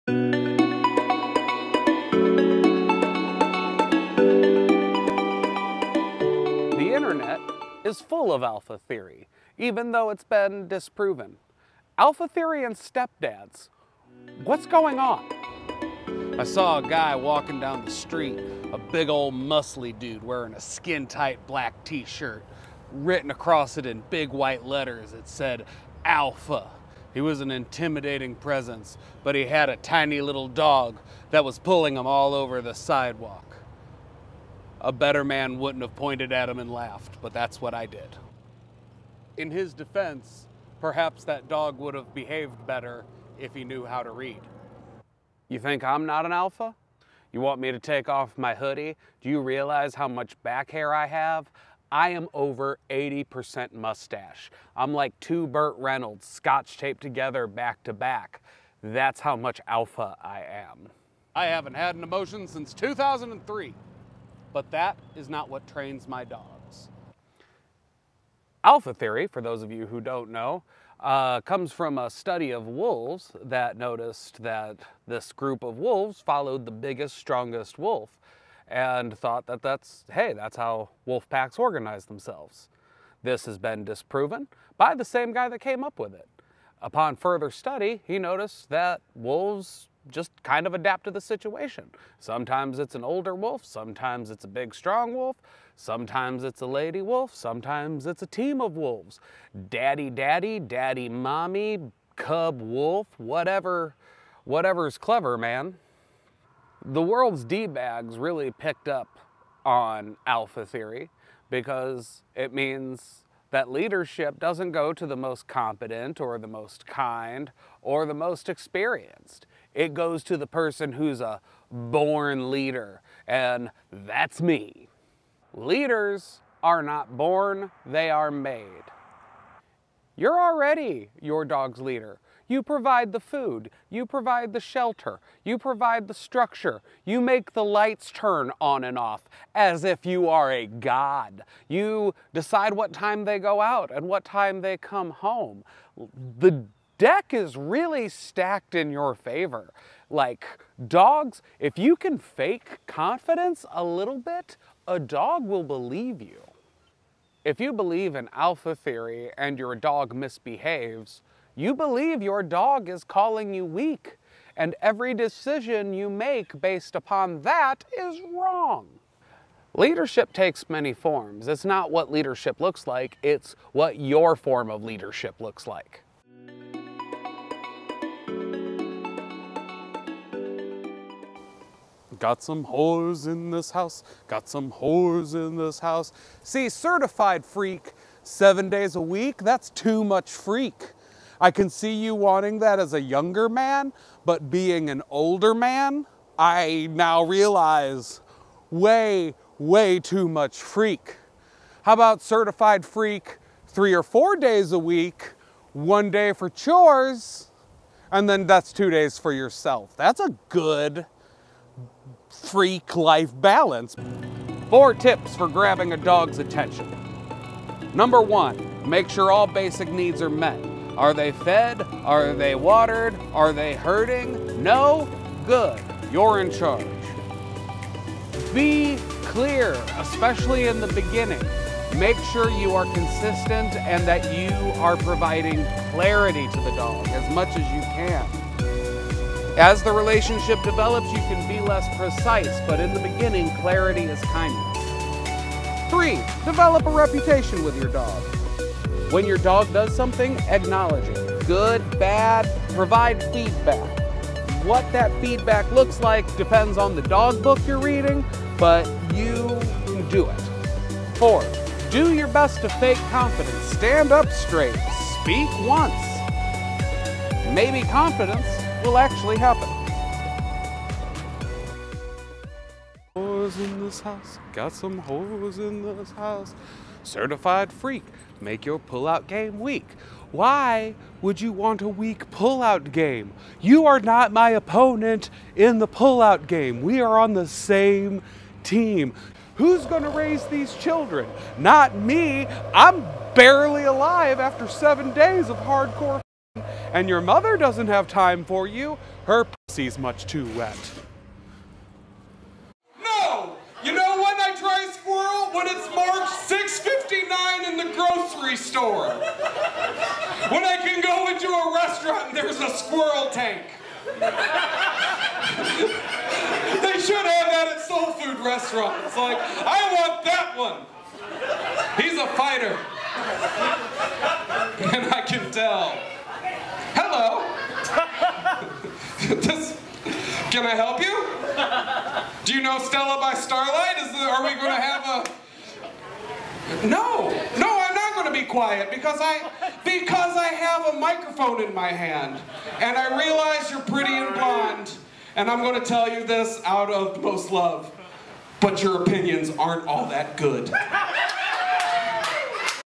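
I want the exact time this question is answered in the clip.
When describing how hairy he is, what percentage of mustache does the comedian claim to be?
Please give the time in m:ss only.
0:52.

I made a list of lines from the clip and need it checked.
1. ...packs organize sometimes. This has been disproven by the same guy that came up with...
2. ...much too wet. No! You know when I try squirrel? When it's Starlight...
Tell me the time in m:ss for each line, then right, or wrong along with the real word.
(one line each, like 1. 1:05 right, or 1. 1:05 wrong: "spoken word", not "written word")
1. 1:21 wrong: "themselves", not "sometimes"
2. 4:59 wrong: "March", not "Starlight".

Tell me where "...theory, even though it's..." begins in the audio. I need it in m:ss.
0:08.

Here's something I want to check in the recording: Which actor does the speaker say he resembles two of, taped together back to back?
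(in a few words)
Burt Reynolds.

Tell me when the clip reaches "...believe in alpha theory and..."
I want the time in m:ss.
2:37.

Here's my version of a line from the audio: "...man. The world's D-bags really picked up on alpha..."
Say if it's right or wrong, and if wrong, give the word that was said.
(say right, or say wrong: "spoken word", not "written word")
right.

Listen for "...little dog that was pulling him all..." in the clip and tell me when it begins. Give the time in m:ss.
0:30.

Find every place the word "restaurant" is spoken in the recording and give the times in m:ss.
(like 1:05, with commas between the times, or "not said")
5:11, 5:18.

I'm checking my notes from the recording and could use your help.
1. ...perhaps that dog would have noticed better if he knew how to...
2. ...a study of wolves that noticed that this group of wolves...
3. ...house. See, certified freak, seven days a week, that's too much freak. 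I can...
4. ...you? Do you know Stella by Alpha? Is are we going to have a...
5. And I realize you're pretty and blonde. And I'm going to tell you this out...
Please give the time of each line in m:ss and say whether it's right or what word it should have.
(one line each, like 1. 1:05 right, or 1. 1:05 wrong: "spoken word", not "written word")
1. 0:40 wrong: "behaved", not "noticed"
2. 1:11 right
3. 3:05 right
4. 5:30 wrong: "Starlight", not "Alpha"
5. 5:42 right.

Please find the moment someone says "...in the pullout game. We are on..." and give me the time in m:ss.
4:45.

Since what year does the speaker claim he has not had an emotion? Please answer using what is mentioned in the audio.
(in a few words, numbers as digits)
2003.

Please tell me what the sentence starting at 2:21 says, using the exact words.
You decide what time they go out and what time they come home.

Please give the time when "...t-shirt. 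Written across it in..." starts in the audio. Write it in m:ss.
0:21.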